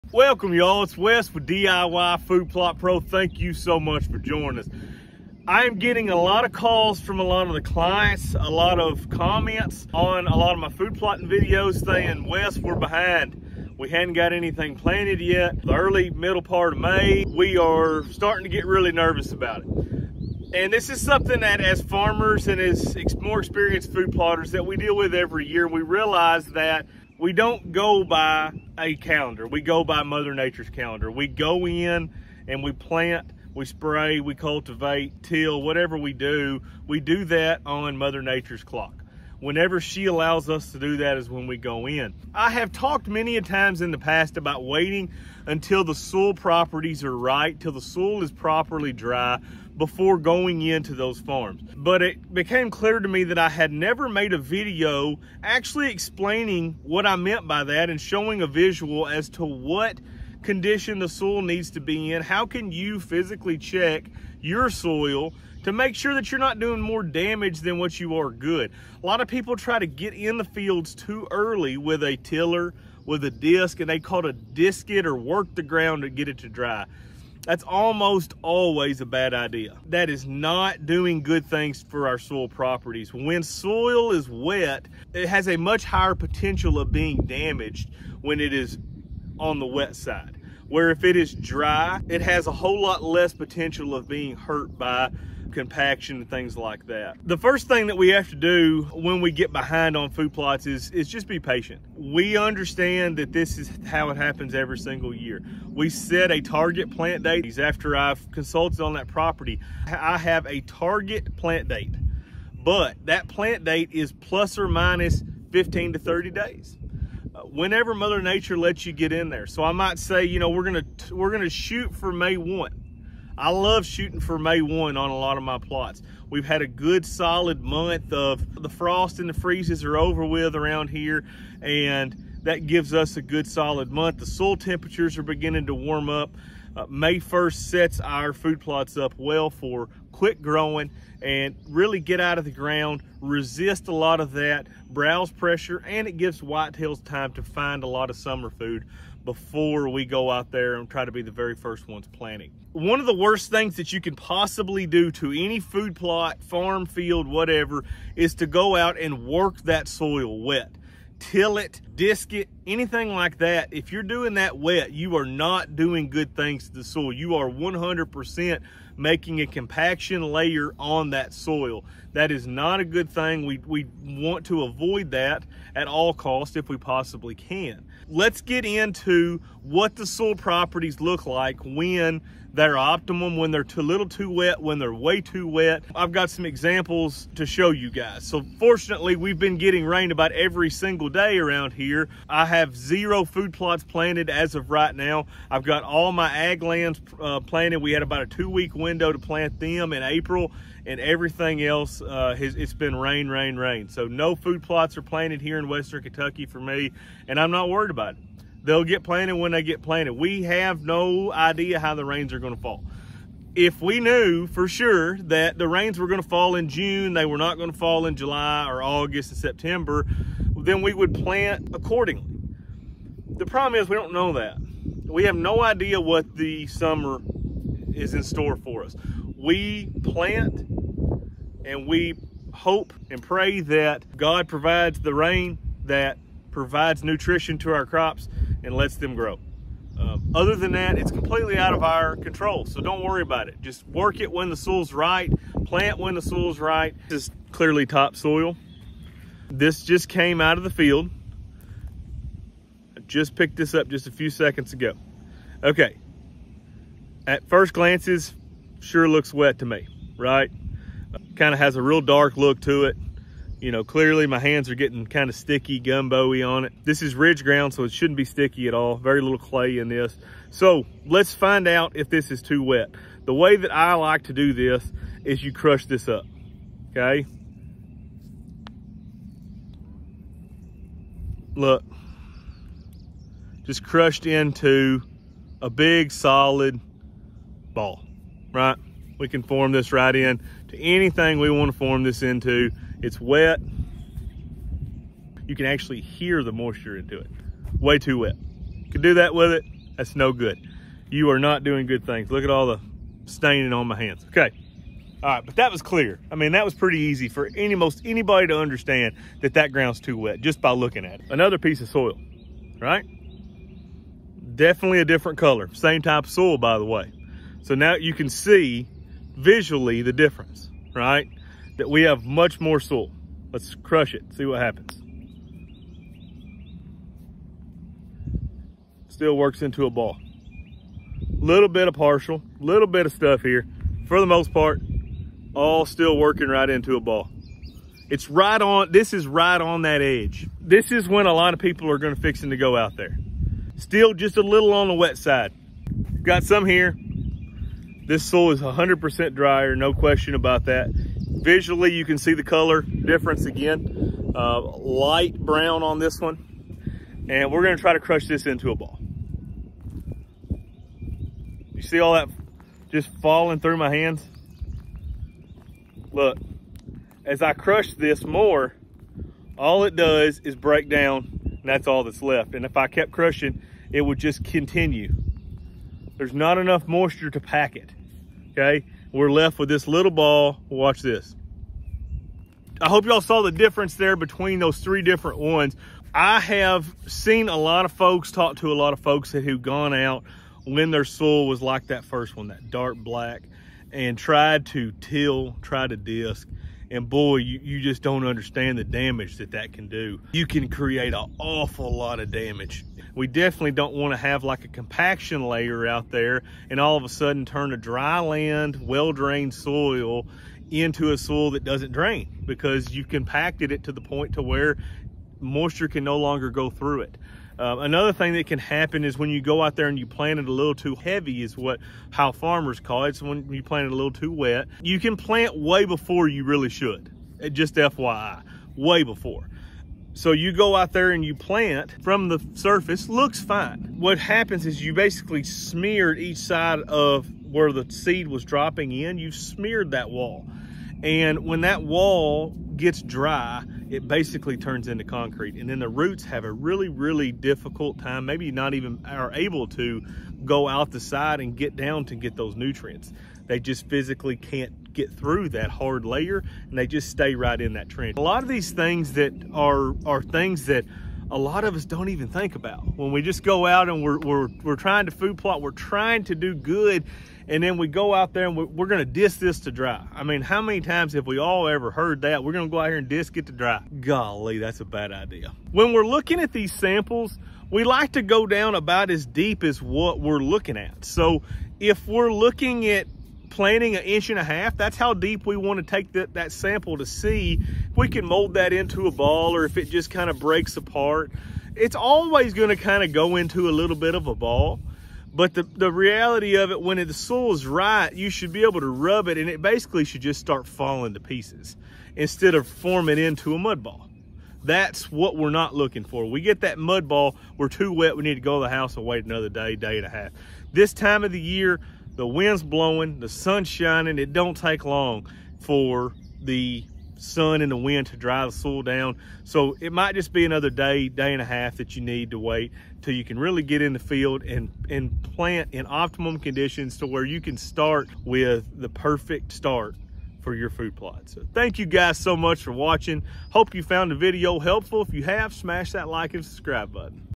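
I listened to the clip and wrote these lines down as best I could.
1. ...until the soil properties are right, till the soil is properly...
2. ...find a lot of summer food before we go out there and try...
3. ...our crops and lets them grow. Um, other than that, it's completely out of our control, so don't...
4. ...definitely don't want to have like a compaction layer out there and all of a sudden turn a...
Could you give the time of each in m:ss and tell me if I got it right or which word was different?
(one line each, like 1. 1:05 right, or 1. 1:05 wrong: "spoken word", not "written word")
1. 0:45 right
2. 2:27 right
3. 3:57 right
4. 6:43 right.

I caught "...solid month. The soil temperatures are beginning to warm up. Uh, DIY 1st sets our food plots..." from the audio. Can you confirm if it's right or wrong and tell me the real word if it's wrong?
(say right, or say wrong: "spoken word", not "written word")
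wrong: "May", not "DIY".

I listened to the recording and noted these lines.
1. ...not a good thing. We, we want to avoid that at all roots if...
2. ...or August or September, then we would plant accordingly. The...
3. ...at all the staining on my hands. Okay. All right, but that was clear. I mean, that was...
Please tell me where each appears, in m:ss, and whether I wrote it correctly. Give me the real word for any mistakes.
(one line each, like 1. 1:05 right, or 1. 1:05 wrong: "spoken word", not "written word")
1. 2:52 wrong: "costs", not "roots"
2. 3:38 right
3. 5:02 right.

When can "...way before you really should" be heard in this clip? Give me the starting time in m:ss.
7:05.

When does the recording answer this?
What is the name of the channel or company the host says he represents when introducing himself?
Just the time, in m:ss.
0:01.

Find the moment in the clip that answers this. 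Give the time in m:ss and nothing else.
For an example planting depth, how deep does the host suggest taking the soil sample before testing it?
8:03.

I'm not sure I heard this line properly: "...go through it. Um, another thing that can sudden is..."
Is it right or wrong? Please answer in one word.
wrong.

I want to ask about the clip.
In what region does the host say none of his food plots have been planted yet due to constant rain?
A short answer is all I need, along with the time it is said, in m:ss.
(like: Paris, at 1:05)
Western Kentucky, at 3:25.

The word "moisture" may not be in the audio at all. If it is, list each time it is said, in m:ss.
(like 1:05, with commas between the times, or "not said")
4:56, 6:16, 6:55.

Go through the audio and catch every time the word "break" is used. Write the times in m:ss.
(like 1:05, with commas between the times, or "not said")
6:10, 8:10.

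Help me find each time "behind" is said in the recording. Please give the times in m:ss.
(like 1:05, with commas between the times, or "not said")
0:12, 1:39.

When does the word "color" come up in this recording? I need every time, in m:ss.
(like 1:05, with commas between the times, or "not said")
5:15, 5:52.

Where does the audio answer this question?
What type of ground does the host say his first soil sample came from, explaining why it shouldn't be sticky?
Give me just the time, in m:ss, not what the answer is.
4:27.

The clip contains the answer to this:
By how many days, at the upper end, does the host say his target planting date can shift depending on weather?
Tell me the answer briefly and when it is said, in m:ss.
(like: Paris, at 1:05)
30, at 1:55.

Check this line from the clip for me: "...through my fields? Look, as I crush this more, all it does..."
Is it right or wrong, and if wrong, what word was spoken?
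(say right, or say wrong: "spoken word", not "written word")
wrong: "hands", not "fields".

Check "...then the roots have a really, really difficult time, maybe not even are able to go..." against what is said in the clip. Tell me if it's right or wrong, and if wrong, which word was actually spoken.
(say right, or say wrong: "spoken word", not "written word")
right.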